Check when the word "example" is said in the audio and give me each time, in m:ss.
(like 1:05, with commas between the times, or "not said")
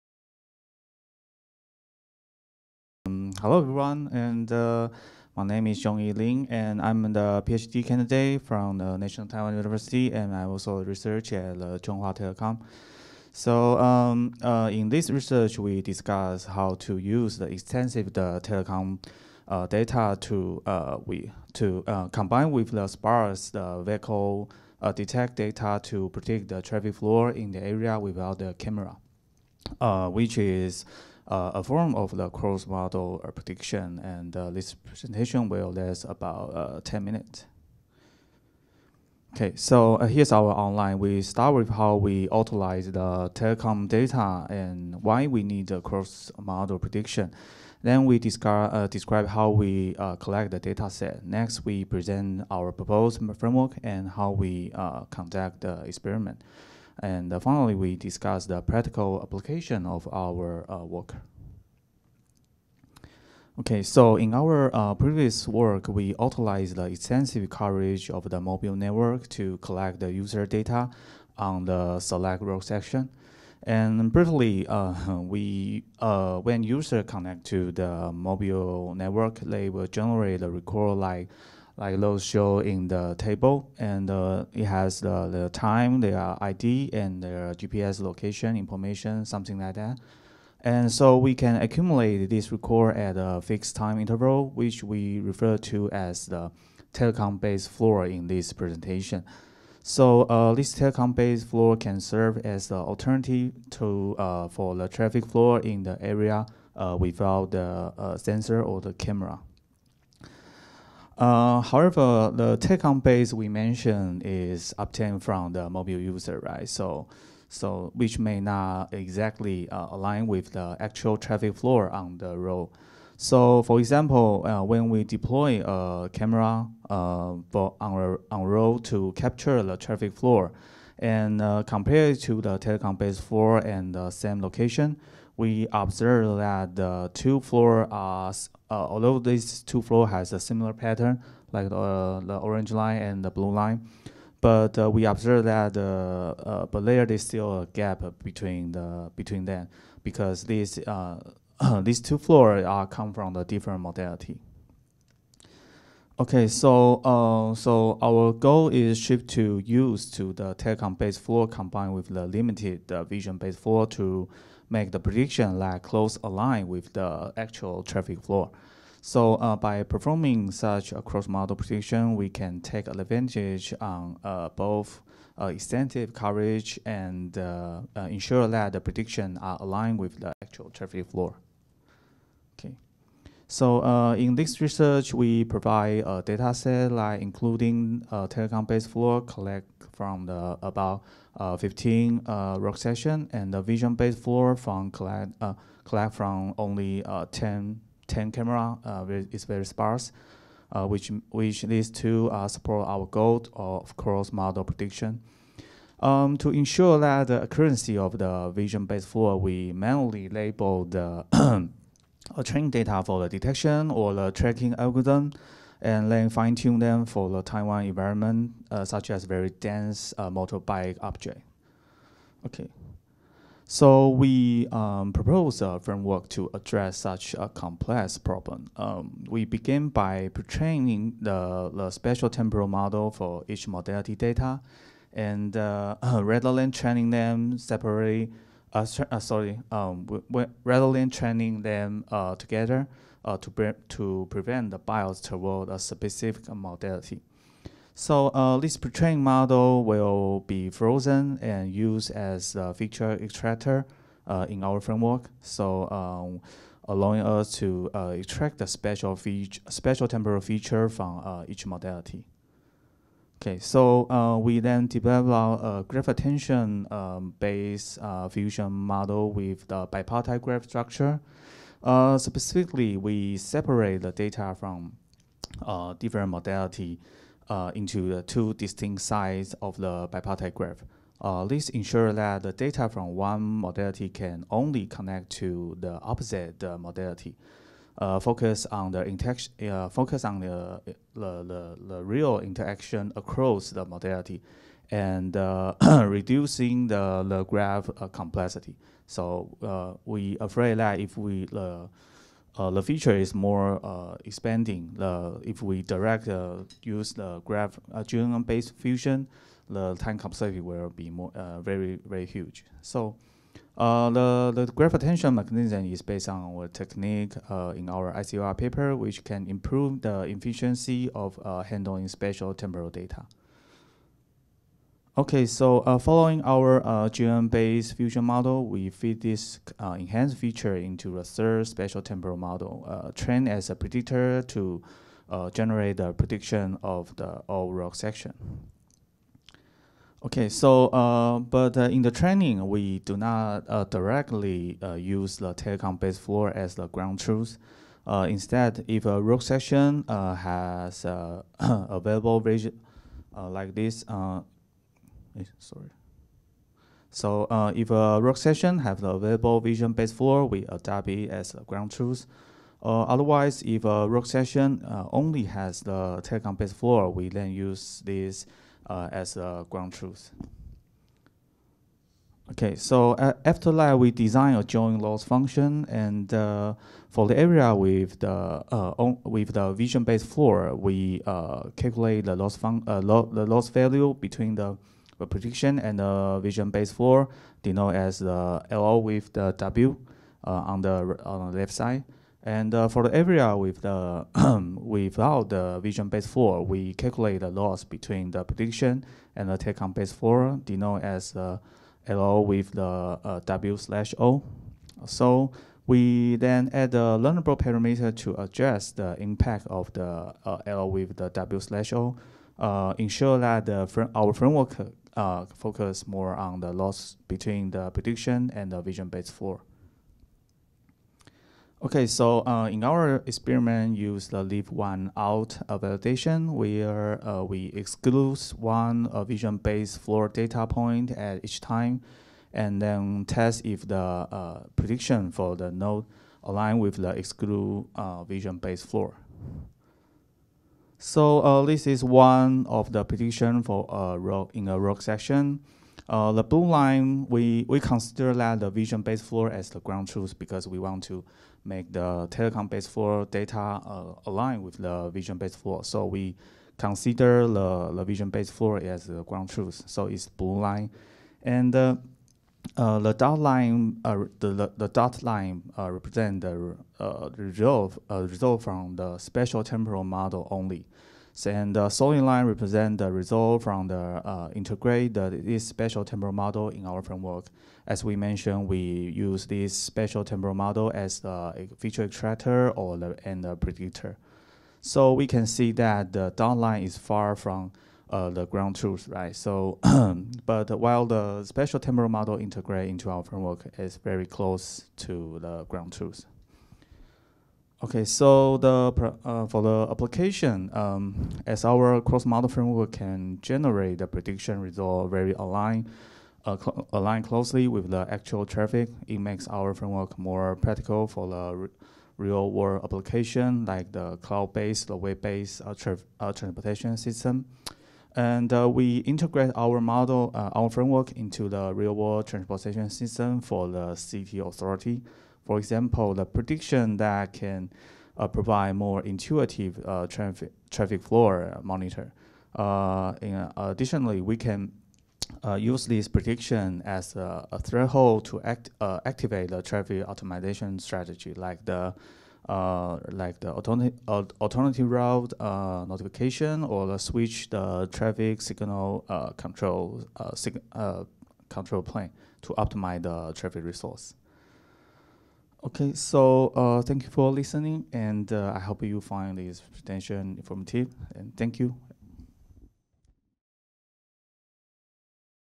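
2:03, 8:45.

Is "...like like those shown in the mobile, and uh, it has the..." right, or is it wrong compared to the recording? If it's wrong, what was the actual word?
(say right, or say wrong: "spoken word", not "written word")
wrong: "table", not "mobile".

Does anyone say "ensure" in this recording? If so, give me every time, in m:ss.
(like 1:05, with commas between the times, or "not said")
2:58, 3:26, 4:41, 6:52.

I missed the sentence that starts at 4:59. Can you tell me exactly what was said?
So we afraid that if we uh, the feature is more uh, expanding.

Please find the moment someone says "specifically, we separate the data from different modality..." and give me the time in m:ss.
4:32.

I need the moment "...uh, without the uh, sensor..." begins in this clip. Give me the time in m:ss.
1:46.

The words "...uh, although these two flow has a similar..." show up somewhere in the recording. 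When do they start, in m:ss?
2:18.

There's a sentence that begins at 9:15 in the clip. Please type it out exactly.
Okay, so thank you for listening, and I hope you find this presentation informative.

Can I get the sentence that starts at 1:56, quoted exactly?
So so which may not exactly uh, align with the actual traffic flow on the road.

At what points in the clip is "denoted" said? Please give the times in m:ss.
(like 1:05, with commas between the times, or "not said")
6:27, 6:40.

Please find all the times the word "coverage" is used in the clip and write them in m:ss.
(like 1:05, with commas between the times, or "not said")
1:07, 2:56.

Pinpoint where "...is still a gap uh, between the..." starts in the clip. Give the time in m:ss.
2:27.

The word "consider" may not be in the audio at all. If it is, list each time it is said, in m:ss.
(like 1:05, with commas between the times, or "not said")
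7:27, 7:36.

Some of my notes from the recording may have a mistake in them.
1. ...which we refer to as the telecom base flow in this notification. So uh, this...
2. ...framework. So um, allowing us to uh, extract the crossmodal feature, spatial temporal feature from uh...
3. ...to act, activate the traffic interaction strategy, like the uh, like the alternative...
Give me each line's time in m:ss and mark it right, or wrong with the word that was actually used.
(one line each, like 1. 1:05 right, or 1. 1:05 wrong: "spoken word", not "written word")
1. 1:34 wrong: "presentation", not "notification"
2. 4:14 wrong: "spatial", not "crossmodal"
3. 8:58 wrong: "optimization", not "interaction".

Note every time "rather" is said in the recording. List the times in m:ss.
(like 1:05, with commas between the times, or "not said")
3:56, 4:00.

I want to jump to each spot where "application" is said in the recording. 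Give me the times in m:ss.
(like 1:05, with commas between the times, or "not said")
0:59, 8:19, 8:32.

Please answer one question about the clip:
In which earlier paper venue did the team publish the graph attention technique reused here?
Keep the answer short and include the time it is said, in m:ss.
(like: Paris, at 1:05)
ICOR, at 5:18.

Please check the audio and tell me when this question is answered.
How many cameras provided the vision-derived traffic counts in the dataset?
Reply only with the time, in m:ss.
3:17.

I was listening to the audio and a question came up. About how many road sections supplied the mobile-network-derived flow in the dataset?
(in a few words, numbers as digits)
15.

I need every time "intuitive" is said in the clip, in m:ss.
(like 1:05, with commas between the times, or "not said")
8:49.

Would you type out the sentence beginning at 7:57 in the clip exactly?
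As we mentioned, we use this spatial temporal model as a feature extractor or the, and the predictor.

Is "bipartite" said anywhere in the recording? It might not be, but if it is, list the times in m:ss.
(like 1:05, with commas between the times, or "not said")
4:29, 4:40.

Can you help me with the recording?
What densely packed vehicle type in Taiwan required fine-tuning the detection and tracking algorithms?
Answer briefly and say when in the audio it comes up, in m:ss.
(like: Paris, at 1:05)
Motorbike, at 3:40.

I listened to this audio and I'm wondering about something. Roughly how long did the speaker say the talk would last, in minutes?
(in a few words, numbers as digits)
10.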